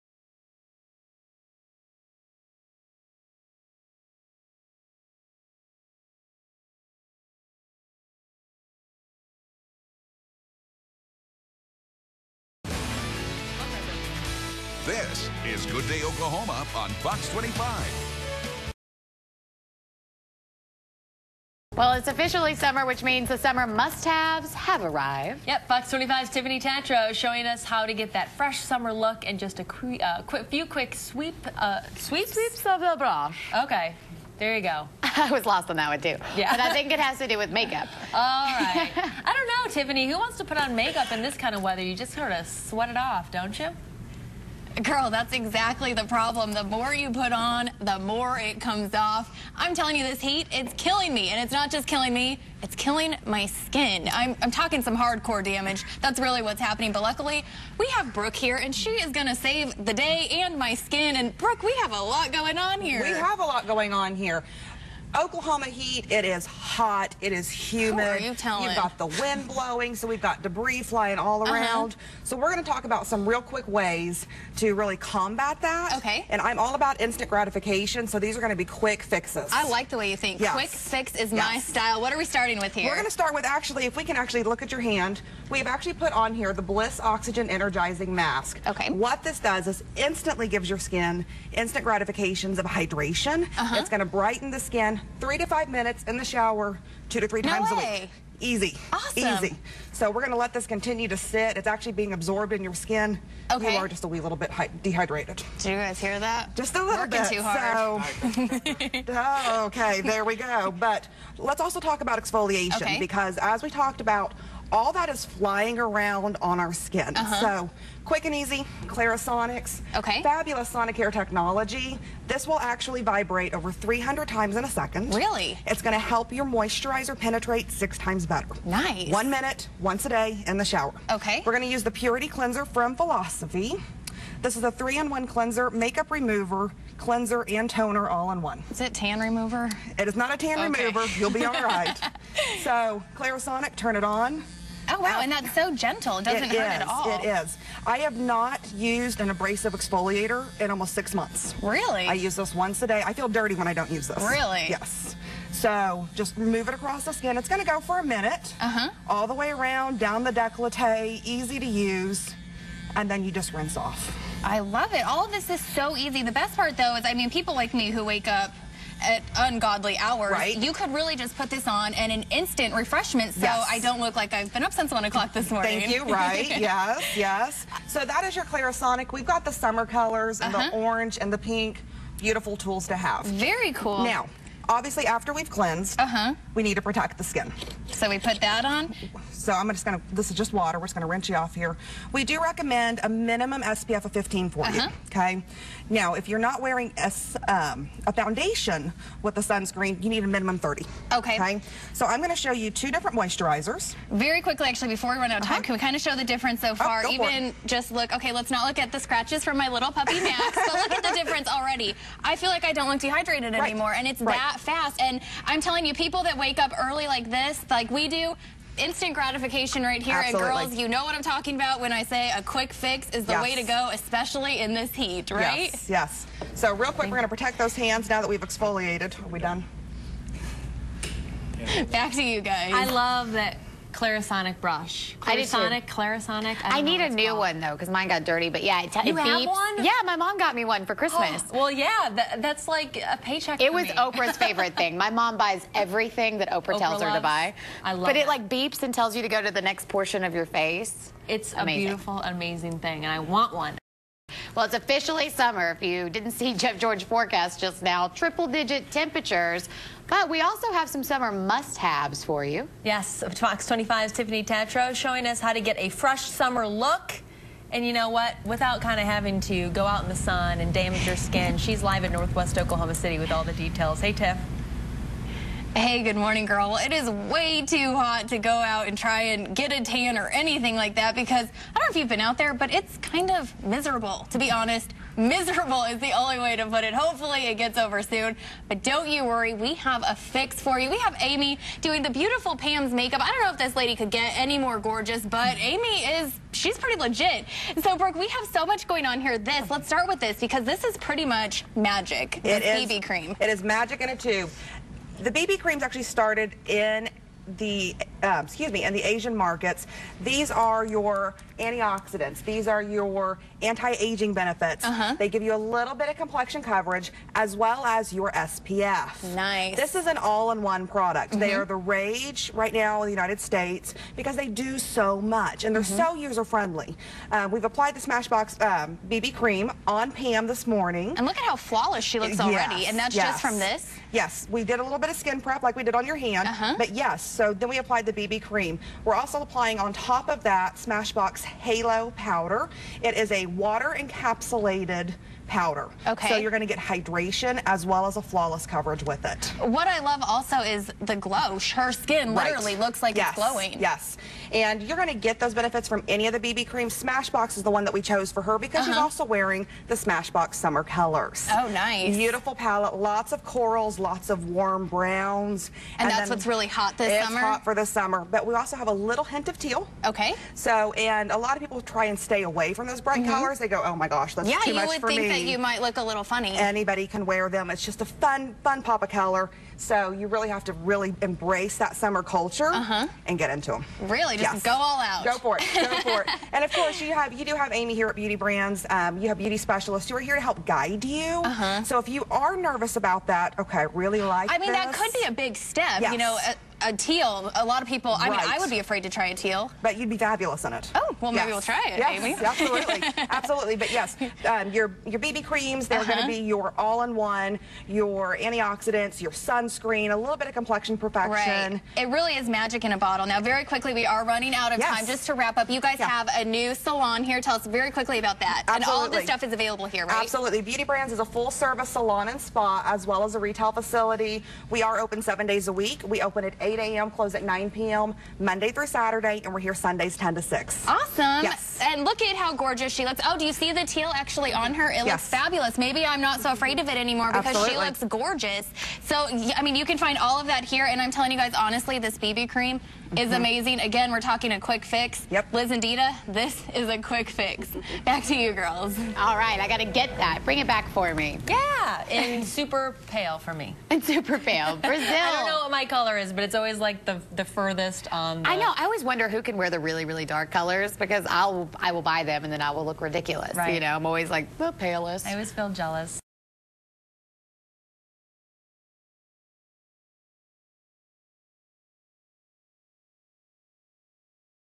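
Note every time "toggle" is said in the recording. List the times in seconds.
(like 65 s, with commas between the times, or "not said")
not said.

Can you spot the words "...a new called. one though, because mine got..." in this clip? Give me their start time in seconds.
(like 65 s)
237 s.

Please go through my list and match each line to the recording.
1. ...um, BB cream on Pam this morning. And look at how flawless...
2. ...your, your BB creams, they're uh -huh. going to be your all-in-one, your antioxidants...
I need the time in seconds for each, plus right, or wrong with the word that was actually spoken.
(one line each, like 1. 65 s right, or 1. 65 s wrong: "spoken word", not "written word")
1. 328 s right
2. 404 s right.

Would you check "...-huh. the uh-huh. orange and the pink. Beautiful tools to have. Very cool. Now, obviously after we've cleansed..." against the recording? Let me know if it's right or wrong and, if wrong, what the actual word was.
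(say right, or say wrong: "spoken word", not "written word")
right.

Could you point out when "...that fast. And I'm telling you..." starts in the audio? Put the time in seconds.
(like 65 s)
214 s.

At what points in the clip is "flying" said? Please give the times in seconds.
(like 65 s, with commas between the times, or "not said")
70 s, 115 s.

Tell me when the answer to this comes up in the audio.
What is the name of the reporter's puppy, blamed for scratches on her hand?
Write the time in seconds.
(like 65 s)
210 s.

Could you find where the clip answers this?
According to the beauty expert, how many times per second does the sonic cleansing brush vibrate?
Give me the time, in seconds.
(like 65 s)
123 s.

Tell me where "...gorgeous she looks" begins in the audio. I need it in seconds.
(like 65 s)
432 s.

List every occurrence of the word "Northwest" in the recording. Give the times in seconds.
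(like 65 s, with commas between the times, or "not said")
272 s.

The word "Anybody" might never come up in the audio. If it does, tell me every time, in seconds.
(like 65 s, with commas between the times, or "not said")
376 s.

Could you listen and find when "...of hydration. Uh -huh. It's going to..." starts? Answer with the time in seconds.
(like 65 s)
92 s.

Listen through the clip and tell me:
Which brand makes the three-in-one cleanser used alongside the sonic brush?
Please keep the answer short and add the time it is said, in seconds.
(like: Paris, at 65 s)
Philosophy, at 132 s.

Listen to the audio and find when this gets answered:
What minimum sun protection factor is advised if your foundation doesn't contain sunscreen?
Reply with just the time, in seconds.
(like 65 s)
200 s.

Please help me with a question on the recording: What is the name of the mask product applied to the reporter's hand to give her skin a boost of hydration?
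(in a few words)
Bliss Oxygen Energizing Mask.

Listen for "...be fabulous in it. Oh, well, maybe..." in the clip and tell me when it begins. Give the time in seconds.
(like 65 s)
400 s.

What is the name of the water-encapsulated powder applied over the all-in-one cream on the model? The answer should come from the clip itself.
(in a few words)
Smashbox Halo powder.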